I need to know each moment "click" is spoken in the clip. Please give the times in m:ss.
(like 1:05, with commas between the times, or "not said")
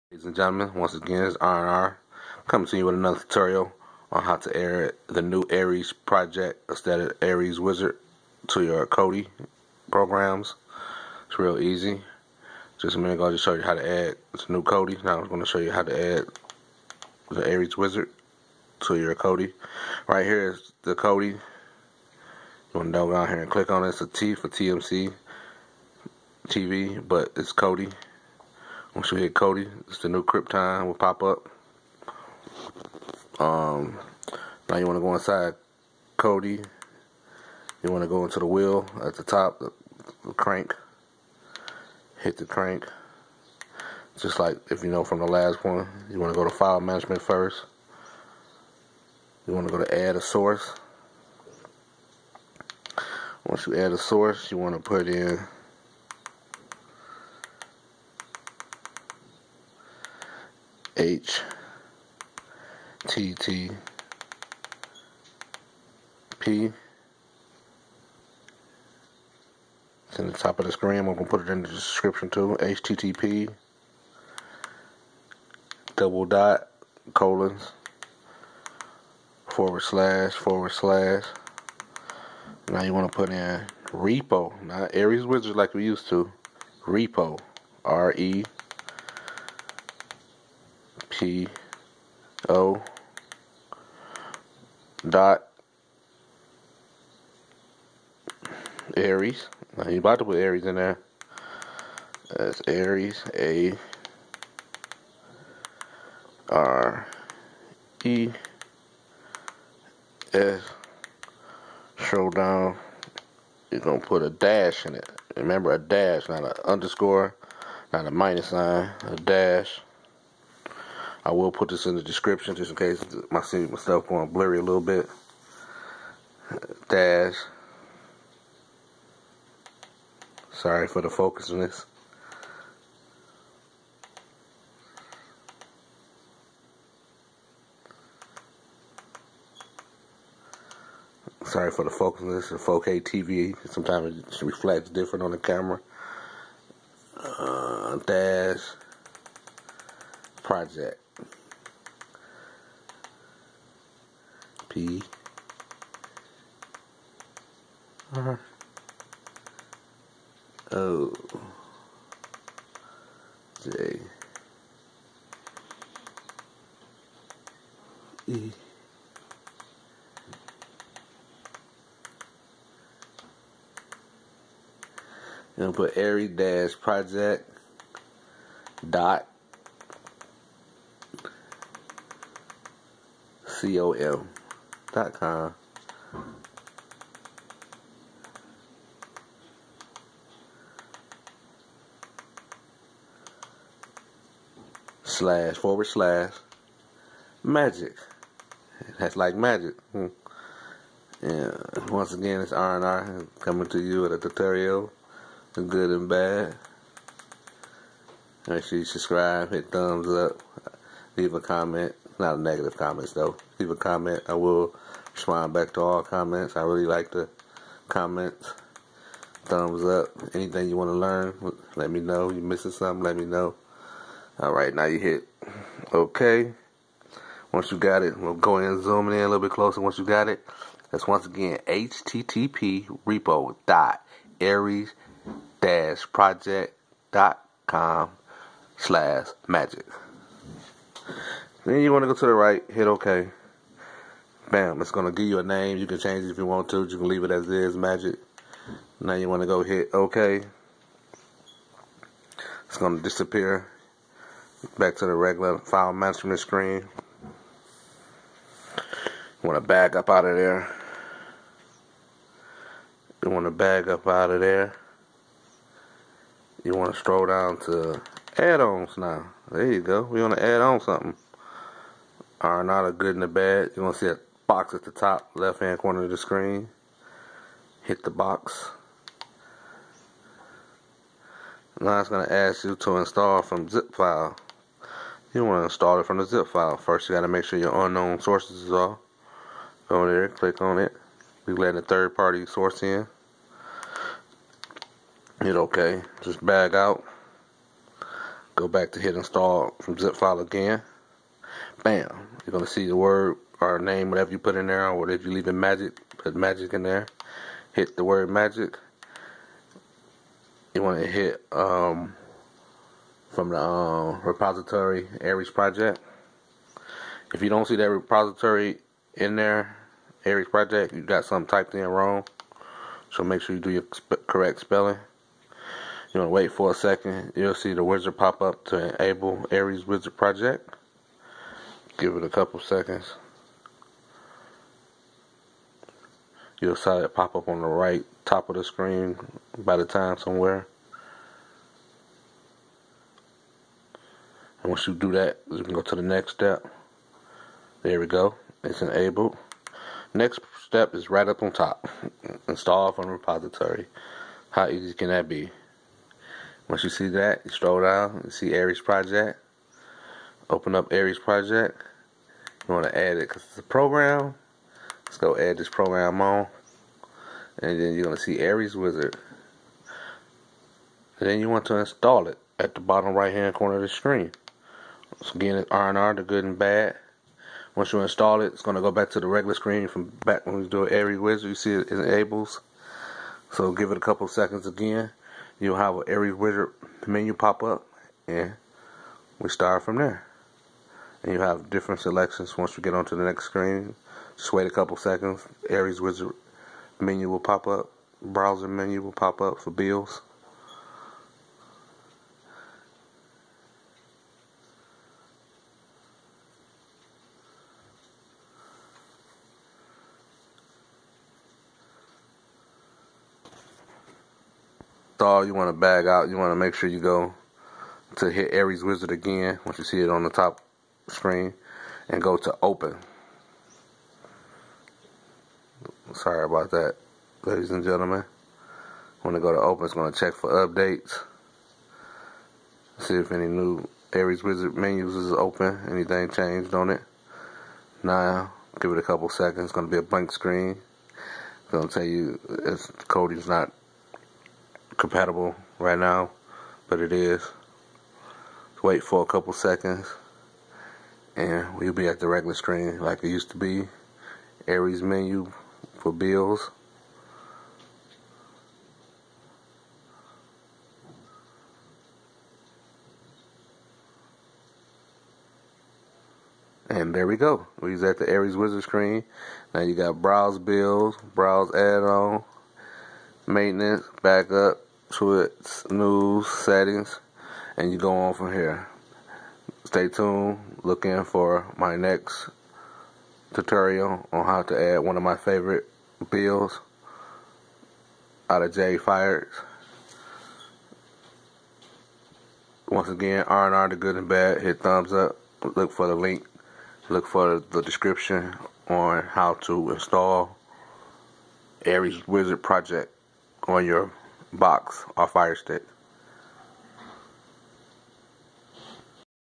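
0:23, 4:50.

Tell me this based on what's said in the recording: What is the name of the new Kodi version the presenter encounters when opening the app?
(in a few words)
Krypton.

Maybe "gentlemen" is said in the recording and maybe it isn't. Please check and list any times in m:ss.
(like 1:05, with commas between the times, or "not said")
0:00, 7:07.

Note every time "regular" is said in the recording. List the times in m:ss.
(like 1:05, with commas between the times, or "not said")
4:15, 6:19, 7:32.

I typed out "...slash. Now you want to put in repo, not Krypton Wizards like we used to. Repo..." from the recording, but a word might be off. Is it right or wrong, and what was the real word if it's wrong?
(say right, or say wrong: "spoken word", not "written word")
wrong: "Ares", not "Krypton".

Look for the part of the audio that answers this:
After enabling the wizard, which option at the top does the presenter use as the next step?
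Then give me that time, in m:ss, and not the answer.
5:52.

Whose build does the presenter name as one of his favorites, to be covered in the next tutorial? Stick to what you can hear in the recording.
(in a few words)
J Fires.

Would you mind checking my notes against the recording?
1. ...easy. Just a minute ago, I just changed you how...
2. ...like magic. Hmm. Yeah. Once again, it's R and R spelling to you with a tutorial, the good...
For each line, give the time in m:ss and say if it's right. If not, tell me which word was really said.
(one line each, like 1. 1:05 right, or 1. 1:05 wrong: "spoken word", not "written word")
1. 0:11 wrong: "showed", not "changed"
2. 3:19 wrong: "coming", not "spelling".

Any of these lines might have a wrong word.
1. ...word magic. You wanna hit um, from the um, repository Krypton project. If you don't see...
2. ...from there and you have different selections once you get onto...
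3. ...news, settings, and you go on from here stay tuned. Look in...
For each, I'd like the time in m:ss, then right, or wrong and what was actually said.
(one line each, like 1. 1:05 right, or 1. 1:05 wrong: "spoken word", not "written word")
1. 5:08 wrong: "Ares", not "Krypton"
2. 6:29 right
3. 7:55 right.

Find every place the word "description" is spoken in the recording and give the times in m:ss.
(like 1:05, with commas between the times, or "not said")
1:11, 2:02, 8:17.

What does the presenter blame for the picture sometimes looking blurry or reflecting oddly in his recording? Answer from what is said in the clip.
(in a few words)
4K TV.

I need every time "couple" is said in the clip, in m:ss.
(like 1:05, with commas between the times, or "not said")
5:32, 6:24, 6:34, 7:19, 7:29.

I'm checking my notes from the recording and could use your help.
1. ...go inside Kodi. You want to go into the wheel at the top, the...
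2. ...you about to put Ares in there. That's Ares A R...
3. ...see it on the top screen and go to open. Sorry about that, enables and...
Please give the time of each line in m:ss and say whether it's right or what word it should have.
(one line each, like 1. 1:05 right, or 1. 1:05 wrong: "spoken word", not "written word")
1. 0:35 right
2. 1:39 right
3. 6:59 wrong: "ladies", not "enables".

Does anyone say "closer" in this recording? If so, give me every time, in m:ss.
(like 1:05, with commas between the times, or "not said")
3:49.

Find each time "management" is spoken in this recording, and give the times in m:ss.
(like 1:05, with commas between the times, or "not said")
0:46, 4:15.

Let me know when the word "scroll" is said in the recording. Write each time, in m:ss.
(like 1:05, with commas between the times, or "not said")
4:26, 5:57.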